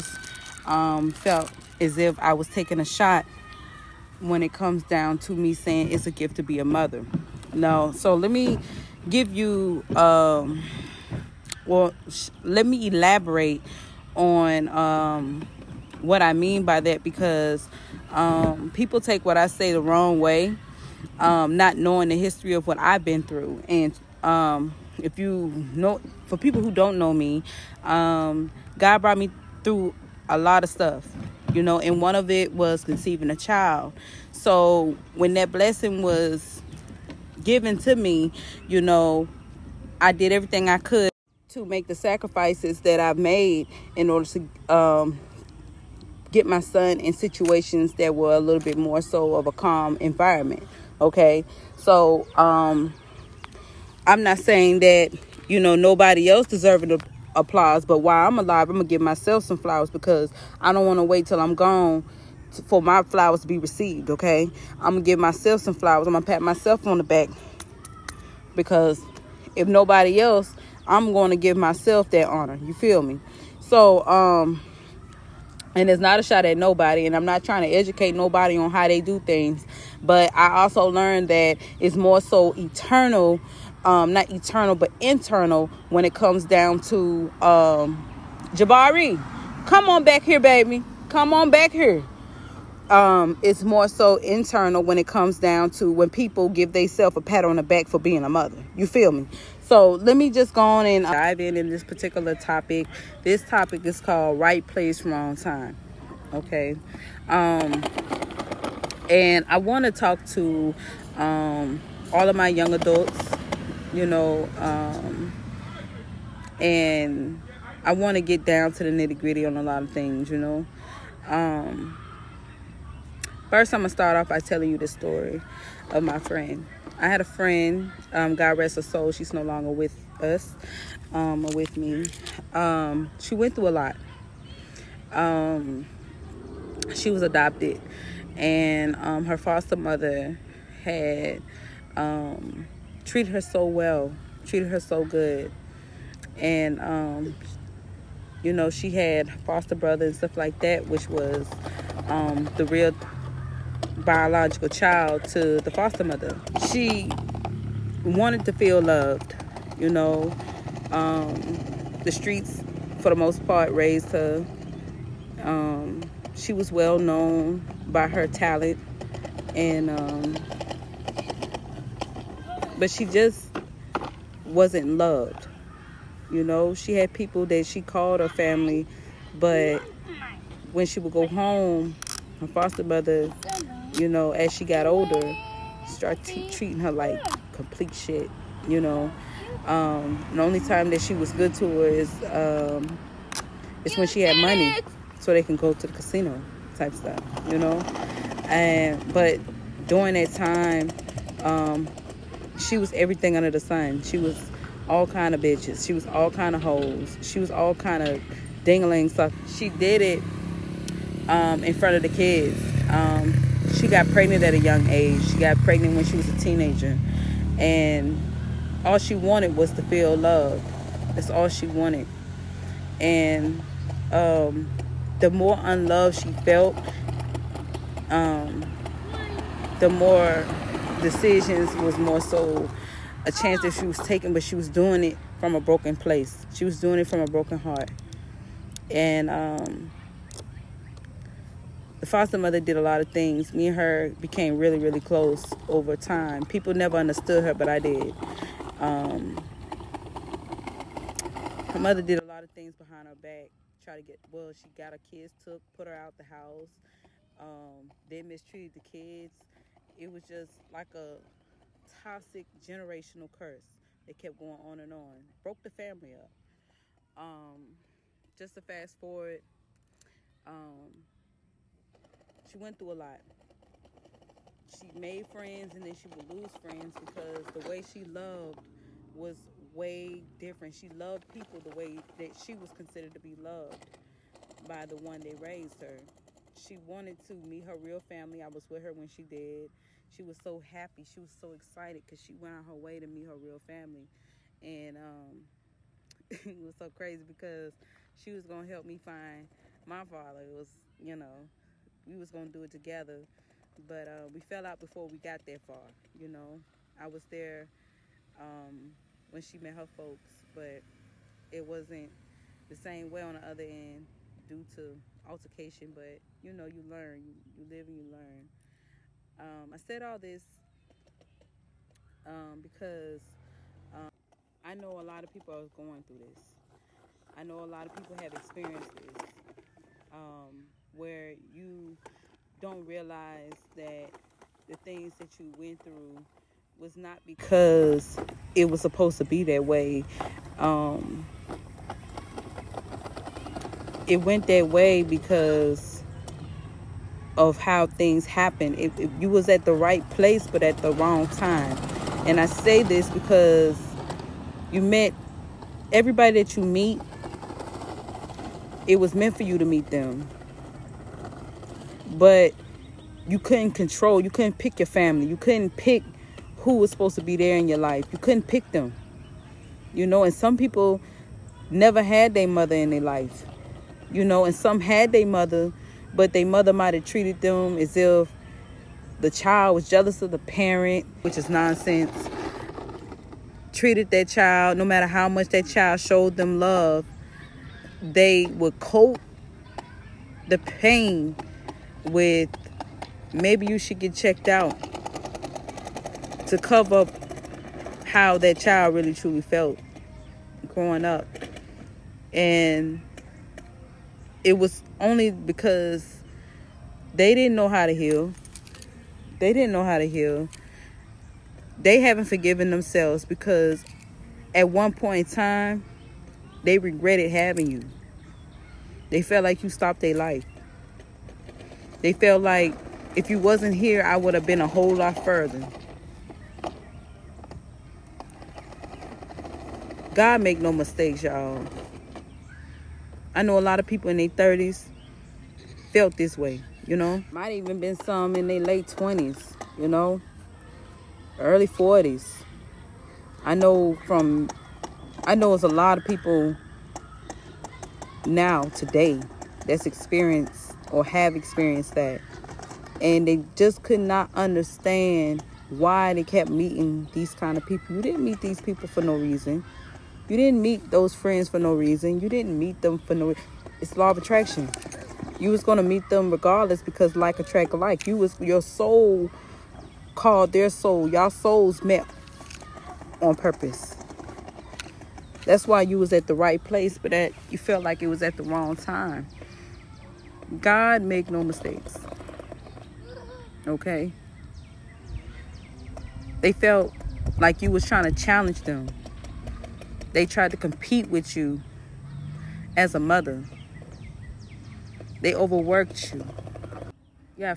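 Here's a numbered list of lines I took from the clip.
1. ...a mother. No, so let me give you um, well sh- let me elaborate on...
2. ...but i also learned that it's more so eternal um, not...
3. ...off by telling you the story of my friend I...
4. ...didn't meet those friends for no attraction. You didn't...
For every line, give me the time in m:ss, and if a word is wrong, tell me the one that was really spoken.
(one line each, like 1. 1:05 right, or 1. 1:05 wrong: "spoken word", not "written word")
1. 0:06 right
2. 1:20 right
3. 2:04 right
4. 7:40 wrong: "reason", not "attraction".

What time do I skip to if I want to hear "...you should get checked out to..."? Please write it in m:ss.
6:33.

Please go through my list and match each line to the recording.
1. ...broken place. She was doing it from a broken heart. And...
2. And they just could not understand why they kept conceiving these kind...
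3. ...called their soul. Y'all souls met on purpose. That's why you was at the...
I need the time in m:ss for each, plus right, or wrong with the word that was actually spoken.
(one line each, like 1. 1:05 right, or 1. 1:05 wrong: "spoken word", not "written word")
1. 3:55 right
2. 7:33 wrong: "meeting", not "conceiving"
3. 7:50 right.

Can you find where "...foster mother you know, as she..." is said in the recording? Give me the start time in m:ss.
3:02.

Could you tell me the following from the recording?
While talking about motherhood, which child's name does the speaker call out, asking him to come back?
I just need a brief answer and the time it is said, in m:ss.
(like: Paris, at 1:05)
Jabari, at 1:28.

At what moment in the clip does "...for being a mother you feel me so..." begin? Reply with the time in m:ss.
1:37.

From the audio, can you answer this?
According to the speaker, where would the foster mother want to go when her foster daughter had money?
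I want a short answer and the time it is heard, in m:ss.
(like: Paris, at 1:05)
The casino, at 3:15.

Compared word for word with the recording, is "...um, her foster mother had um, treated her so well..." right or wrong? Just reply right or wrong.
right.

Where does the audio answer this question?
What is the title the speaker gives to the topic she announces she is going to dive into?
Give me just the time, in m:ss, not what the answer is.
1:44.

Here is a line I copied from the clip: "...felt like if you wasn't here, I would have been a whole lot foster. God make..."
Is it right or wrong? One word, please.
wrong.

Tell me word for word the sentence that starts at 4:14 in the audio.
She got her kids took, put her out the house.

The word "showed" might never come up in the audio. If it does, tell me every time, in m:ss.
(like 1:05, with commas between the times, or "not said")
6:25.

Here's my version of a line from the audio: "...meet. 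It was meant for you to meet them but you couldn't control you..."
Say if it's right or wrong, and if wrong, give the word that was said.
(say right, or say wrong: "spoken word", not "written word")
right.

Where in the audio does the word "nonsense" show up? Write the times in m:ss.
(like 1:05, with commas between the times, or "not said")
6:21.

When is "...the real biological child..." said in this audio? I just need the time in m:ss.
2:32.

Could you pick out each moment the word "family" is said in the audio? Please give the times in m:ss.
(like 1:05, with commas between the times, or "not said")
2:58, 4:25, 4:47, 4:53, 6:04.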